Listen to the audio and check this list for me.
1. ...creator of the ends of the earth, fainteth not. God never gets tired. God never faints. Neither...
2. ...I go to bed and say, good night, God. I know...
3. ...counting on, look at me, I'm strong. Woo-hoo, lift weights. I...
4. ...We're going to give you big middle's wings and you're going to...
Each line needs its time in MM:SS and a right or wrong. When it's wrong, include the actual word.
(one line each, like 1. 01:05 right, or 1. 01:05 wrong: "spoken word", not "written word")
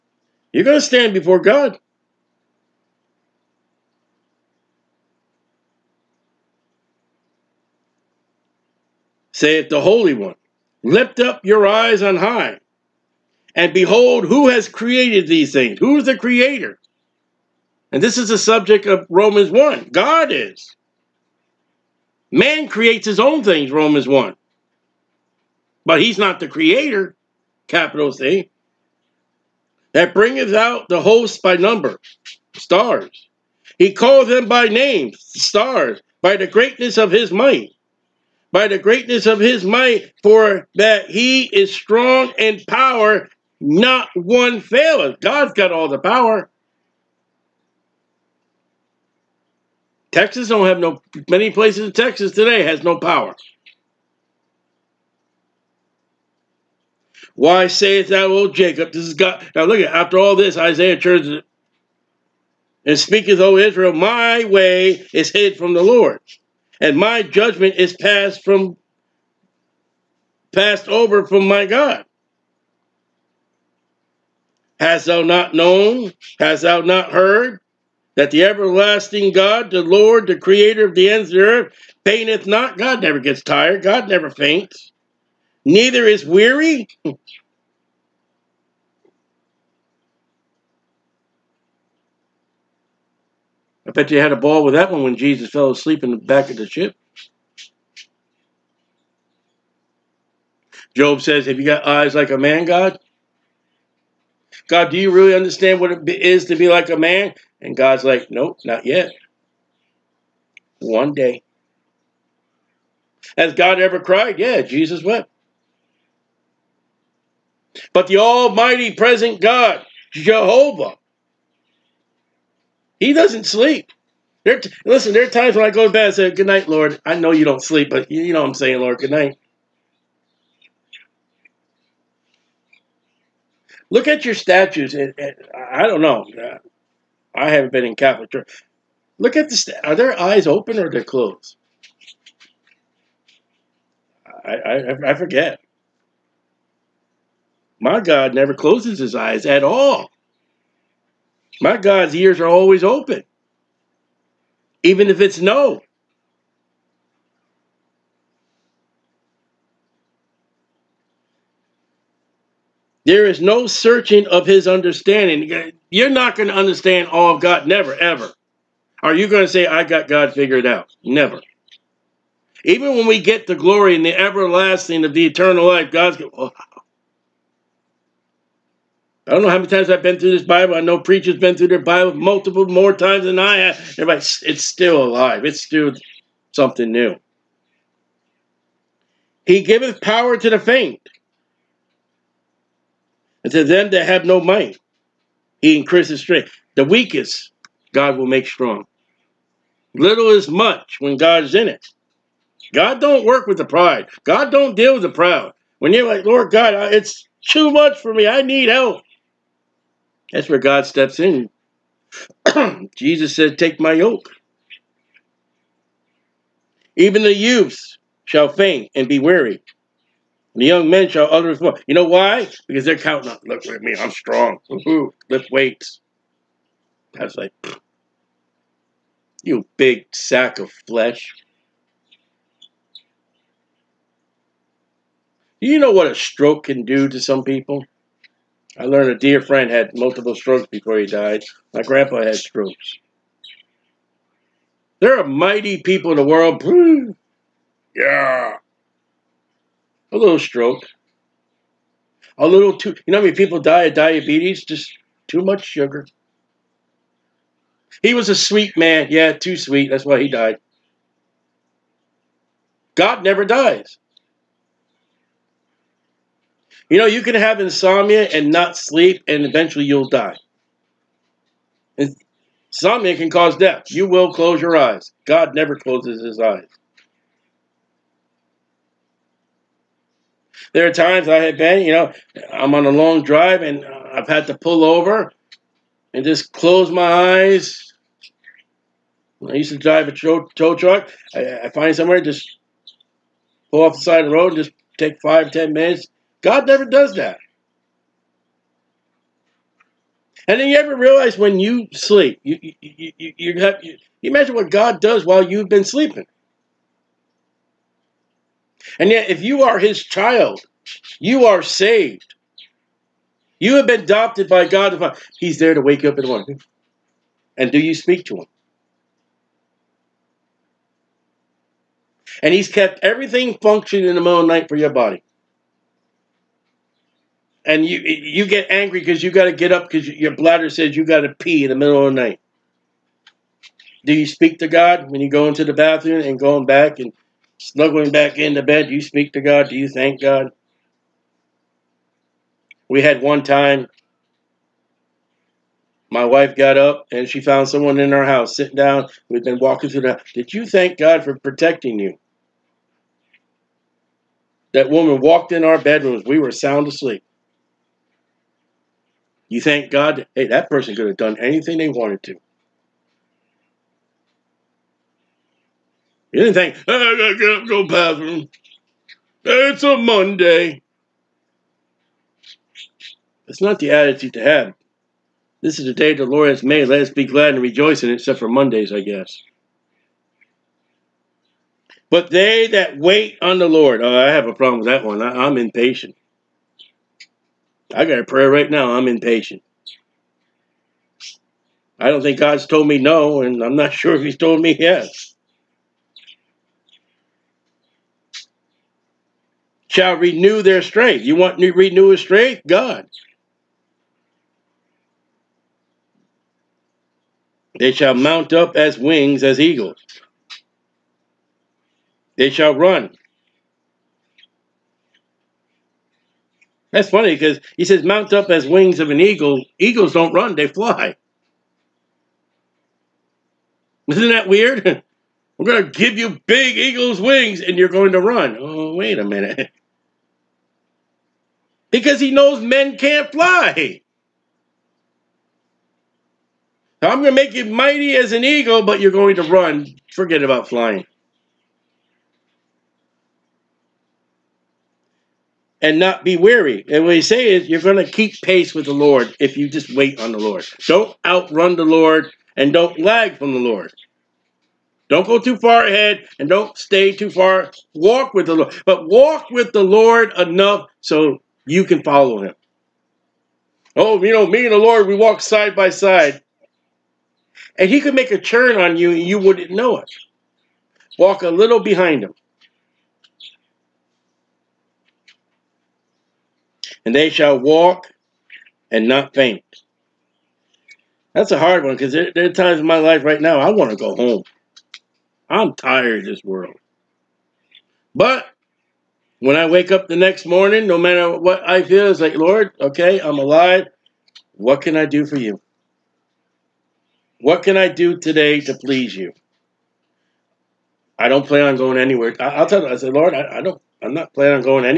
1. 01:20 right
2. 02:05 wrong: "Lord", not "God"
3. 03:42 right
4. 07:05 wrong: "eagle", not "middle".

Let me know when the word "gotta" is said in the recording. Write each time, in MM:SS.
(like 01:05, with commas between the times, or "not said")
06:06.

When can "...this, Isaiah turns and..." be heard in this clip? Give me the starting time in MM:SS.
01:00.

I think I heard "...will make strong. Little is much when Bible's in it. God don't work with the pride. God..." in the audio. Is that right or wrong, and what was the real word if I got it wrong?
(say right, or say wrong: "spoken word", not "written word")
wrong: "God", not "Bible".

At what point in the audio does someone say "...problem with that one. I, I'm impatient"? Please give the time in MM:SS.
06:24.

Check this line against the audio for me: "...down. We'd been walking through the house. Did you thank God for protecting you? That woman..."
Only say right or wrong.
right.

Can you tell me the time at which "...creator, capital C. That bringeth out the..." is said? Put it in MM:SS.
00:26.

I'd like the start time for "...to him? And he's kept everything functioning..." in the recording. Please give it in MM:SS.
05:18.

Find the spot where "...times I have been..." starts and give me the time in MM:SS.
04:40.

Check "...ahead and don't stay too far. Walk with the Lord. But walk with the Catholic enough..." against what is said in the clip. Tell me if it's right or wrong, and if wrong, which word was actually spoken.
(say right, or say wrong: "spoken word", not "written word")
wrong: "Lord", not "Catholic".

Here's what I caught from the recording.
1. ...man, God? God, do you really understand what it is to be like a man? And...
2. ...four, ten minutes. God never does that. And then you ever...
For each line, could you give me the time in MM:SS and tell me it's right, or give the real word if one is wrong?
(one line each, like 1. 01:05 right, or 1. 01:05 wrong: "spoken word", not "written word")
1. 01:42 right
2. 04:55 wrong: "five", not "four".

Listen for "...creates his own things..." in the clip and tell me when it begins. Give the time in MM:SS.
00:22.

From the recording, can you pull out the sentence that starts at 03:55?
Do you know what a stroke can do to some people?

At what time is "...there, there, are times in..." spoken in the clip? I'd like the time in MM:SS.
08:02.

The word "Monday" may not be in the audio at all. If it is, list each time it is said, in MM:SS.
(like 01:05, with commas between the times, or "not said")
06:09, 06:18.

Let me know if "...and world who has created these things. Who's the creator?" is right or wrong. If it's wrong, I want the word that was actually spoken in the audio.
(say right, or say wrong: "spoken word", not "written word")
wrong: "behold", not "world".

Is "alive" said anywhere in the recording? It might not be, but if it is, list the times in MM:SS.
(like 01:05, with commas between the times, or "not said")
03:05, 08:13.